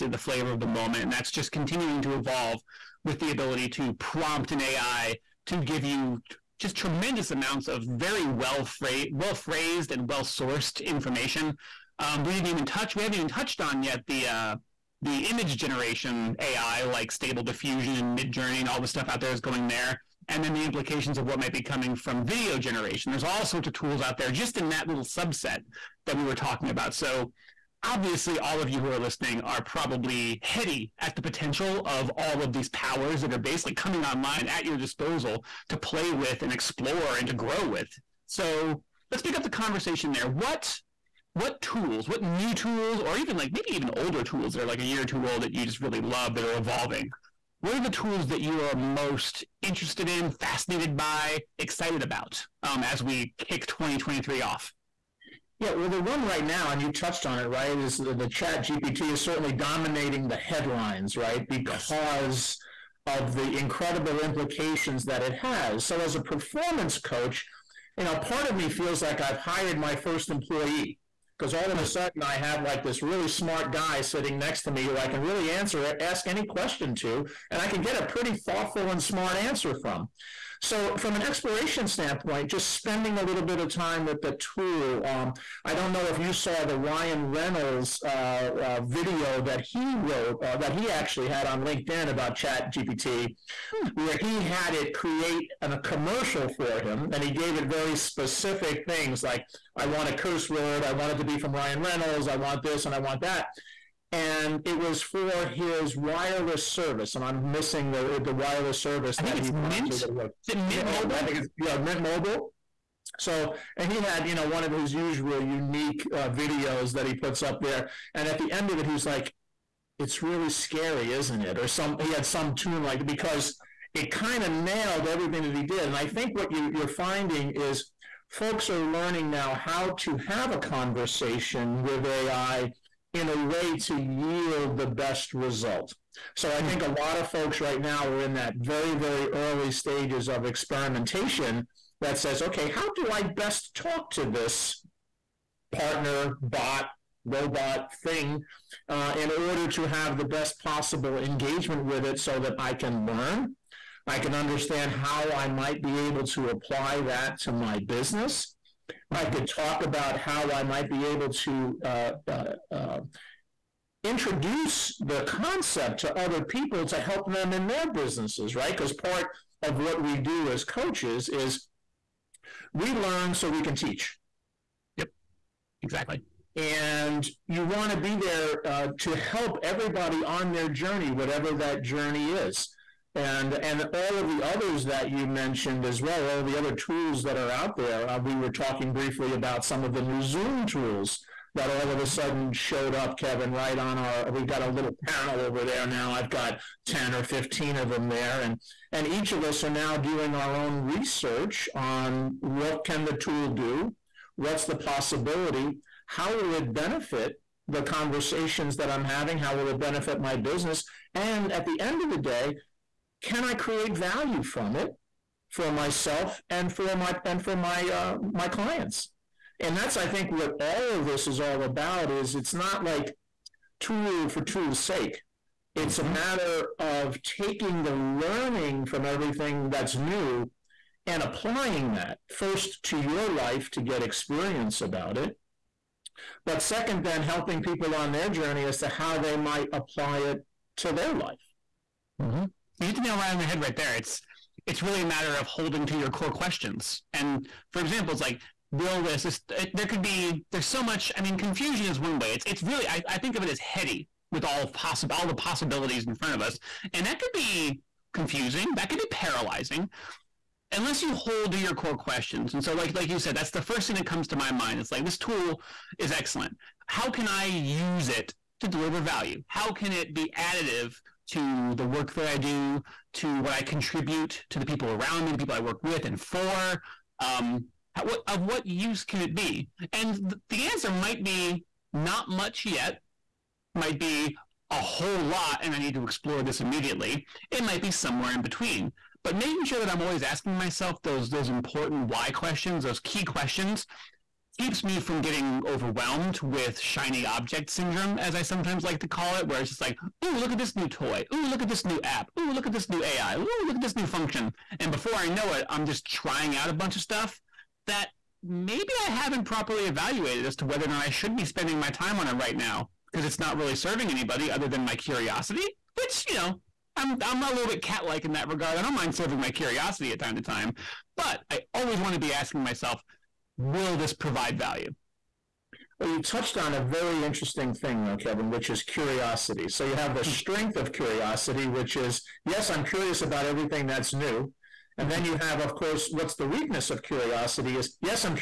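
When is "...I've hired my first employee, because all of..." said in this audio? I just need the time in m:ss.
1:09.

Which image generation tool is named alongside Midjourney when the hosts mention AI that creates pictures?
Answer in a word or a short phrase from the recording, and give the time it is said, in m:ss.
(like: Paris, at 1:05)
Stable Diffusion, at 0:17.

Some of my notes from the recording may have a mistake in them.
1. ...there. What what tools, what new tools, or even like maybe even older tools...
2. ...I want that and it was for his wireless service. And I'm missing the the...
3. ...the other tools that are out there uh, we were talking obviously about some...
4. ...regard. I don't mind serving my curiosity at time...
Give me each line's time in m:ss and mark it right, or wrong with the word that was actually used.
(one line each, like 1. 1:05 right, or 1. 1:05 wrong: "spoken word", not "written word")
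1. 0:40 right
2. 1:42 right
3. 3:06 wrong: "briefly", not "obviously"
4. 5:18 right.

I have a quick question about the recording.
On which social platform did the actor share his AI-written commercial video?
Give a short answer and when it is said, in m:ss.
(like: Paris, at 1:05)
LinkedIn, at 1:31.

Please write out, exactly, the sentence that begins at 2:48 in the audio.
Because part of what we do as coaches is we learn so we can teach.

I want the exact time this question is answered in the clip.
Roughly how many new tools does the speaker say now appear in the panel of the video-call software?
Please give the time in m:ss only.
3:16.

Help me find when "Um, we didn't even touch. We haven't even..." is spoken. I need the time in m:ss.
0:12.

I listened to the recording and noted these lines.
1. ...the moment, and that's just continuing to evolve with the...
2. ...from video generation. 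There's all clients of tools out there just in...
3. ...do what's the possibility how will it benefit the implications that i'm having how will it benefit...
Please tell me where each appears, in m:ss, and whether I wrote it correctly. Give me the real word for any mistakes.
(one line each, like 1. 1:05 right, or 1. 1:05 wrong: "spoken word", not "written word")
1. 0:00 right
2. 0:21 wrong: "sorts", not "clients"
3. 3:23 wrong: "conversations", not "implications".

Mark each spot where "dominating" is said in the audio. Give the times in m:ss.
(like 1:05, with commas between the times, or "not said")
0:59.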